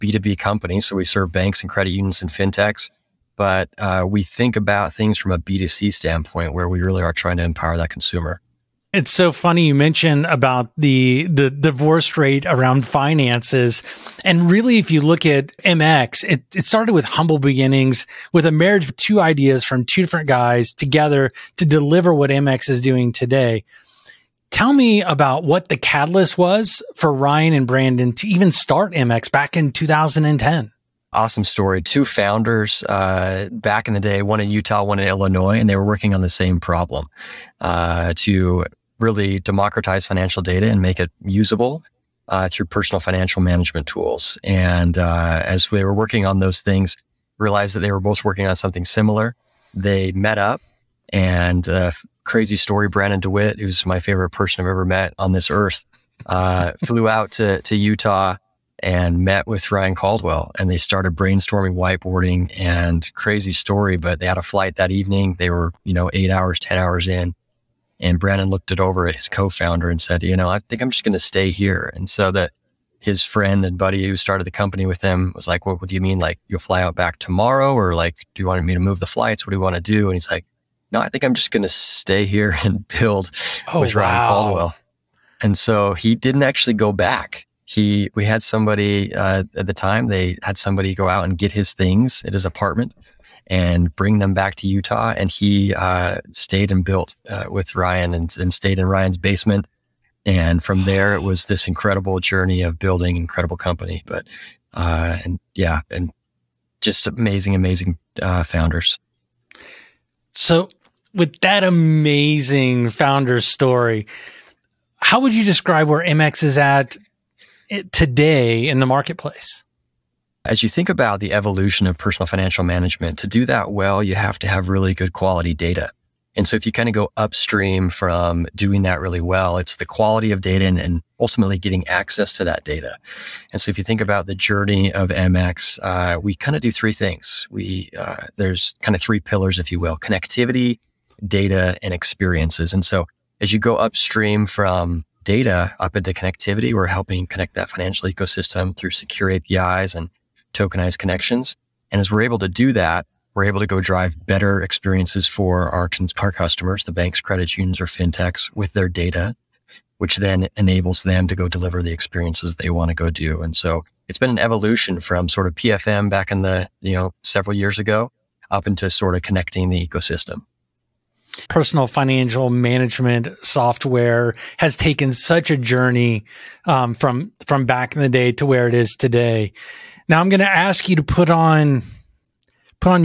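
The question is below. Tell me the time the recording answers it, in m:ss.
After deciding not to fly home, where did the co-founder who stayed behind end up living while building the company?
1:38.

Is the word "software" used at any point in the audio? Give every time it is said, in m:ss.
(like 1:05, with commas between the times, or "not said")
2:53.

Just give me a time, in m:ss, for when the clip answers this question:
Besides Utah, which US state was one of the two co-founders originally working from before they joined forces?
0:35.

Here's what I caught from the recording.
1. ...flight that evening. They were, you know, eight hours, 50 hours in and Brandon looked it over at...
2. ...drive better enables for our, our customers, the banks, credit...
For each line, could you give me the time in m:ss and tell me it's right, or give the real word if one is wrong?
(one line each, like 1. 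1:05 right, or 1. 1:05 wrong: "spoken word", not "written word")
1. 1:04 wrong: "10", not "50"
2. 2:33 wrong: "experiences", not "enables".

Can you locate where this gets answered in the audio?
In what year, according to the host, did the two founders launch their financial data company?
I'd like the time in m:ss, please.
0:29.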